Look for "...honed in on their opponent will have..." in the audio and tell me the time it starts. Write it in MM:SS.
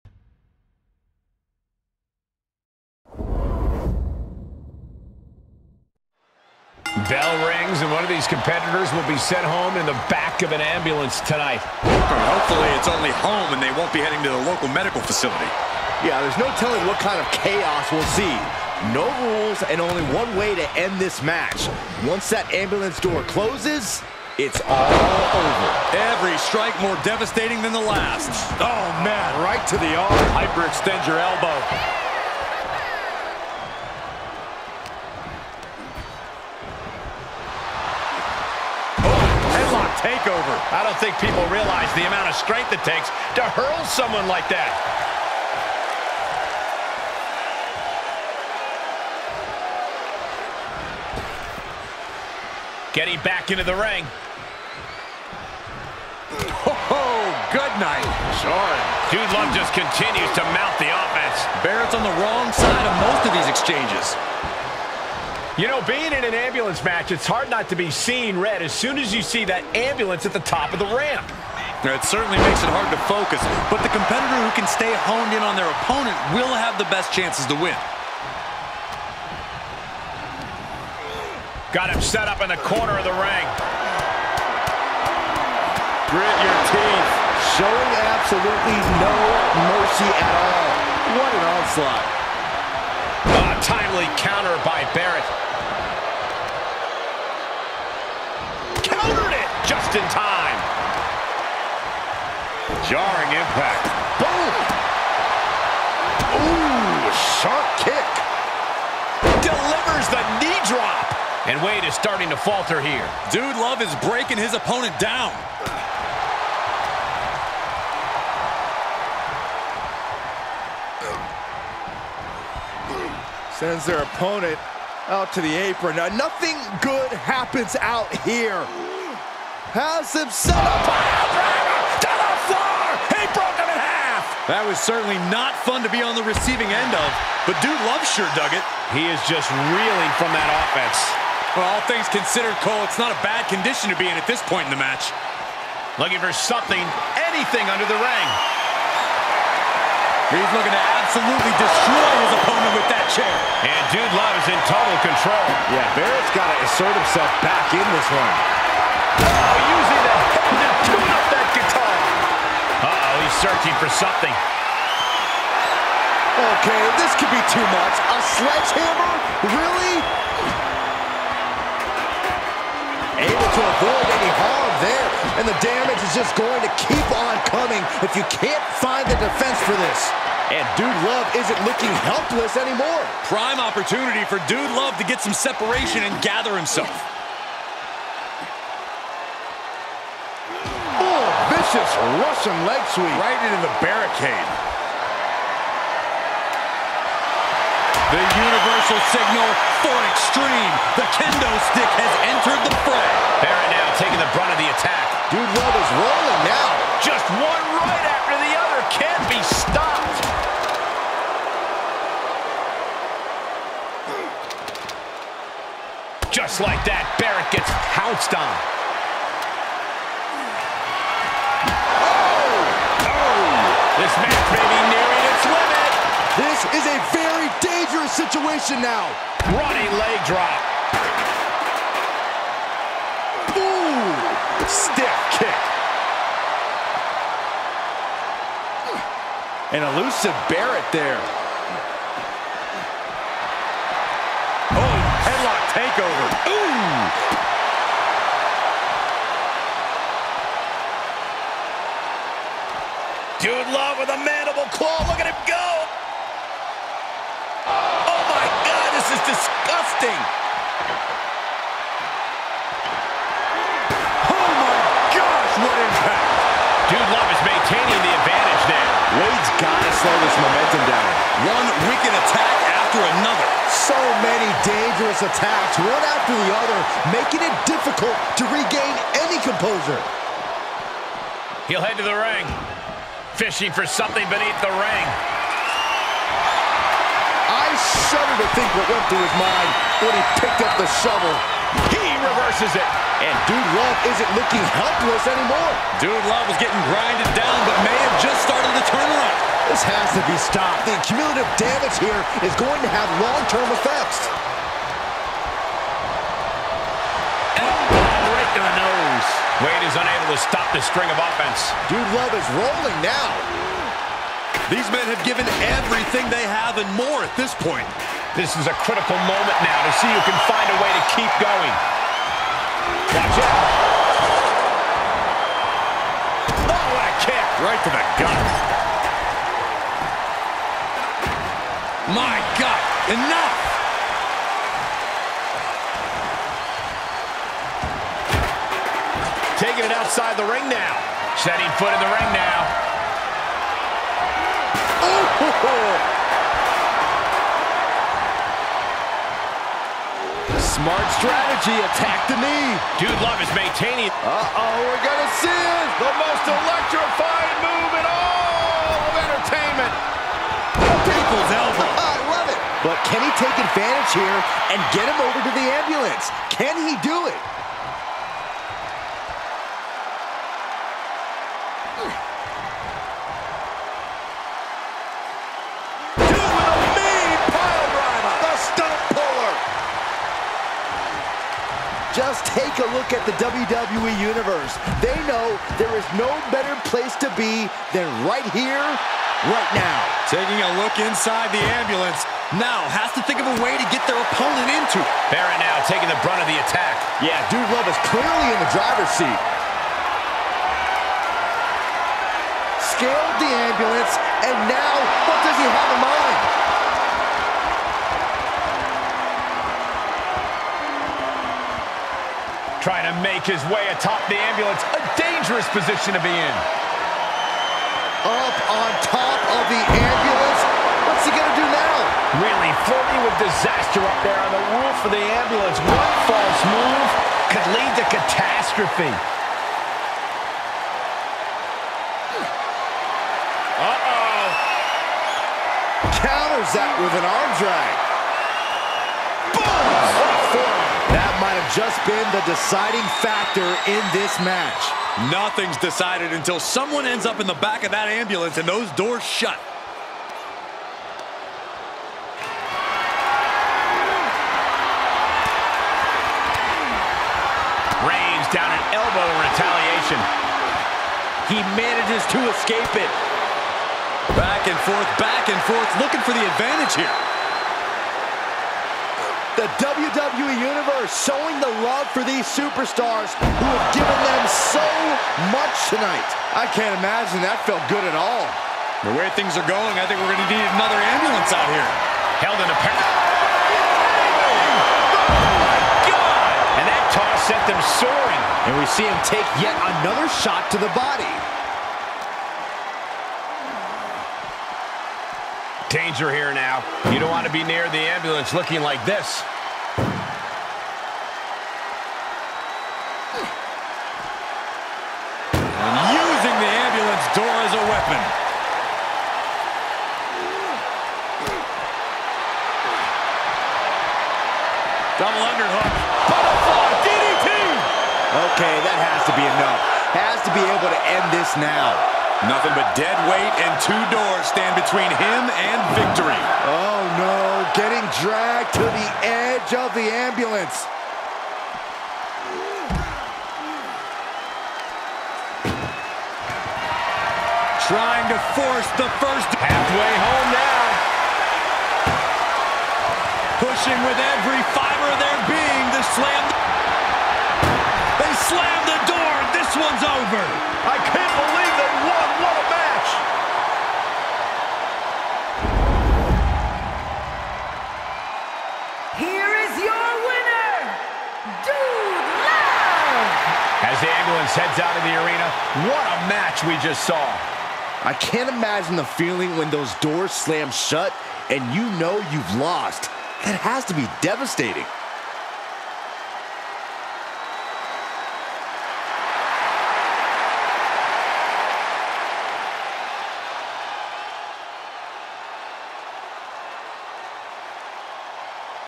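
01:15.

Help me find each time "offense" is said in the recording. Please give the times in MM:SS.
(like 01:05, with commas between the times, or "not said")
01:00, 02:20, 05:11.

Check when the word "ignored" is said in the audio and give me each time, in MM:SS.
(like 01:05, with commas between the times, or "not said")
not said.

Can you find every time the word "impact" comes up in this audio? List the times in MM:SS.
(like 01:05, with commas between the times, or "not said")
01:43, 04:25.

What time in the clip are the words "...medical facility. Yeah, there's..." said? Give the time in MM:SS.
00:14.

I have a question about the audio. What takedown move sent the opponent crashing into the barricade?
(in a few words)
Russian leg sweep.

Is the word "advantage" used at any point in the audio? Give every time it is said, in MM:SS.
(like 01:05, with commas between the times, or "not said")
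04:28, 06:03, 07:46.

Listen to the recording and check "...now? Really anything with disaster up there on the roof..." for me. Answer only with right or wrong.
wrong.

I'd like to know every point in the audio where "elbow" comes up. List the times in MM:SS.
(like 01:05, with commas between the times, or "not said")
00:31, 06:01.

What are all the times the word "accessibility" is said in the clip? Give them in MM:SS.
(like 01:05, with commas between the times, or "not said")
not said.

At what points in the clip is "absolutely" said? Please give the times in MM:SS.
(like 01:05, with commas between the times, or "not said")
01:28, 02:31.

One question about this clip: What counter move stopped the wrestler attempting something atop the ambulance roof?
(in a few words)
Arm drag.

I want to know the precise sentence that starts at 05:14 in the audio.
These men have given everything they have and more at this point.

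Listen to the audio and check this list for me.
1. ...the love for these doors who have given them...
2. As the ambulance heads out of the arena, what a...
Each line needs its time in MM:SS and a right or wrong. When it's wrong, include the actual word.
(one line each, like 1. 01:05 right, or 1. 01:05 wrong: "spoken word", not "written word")
1. 07:51 wrong: "superstars", not "doors"
2. 09:23 right.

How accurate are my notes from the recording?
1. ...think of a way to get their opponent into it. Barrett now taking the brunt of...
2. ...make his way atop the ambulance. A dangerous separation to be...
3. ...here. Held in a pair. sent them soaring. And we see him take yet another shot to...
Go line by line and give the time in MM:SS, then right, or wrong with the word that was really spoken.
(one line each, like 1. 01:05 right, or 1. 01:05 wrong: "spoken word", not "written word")
1. 06:33 right
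2. 06:53 wrong: "position", not "separation"
3. 08:01 right.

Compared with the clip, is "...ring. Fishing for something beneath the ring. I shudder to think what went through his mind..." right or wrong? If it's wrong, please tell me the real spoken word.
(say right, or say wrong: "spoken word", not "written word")
right.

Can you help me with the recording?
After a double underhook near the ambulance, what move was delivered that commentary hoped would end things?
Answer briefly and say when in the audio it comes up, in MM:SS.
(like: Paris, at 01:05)
Butterfly, at 08:36.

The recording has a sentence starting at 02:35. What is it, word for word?
Yeah, Barrett's got to assert himself back in this one.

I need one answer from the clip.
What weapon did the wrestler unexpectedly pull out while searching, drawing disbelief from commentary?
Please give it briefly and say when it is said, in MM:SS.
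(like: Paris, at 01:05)
Sledgehammer, at 02:47.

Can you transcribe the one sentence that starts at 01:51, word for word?
And Wade is starting to falter here.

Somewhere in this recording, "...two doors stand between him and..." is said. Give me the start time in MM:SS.
08:43.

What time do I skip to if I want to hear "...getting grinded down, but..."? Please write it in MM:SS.
04:56.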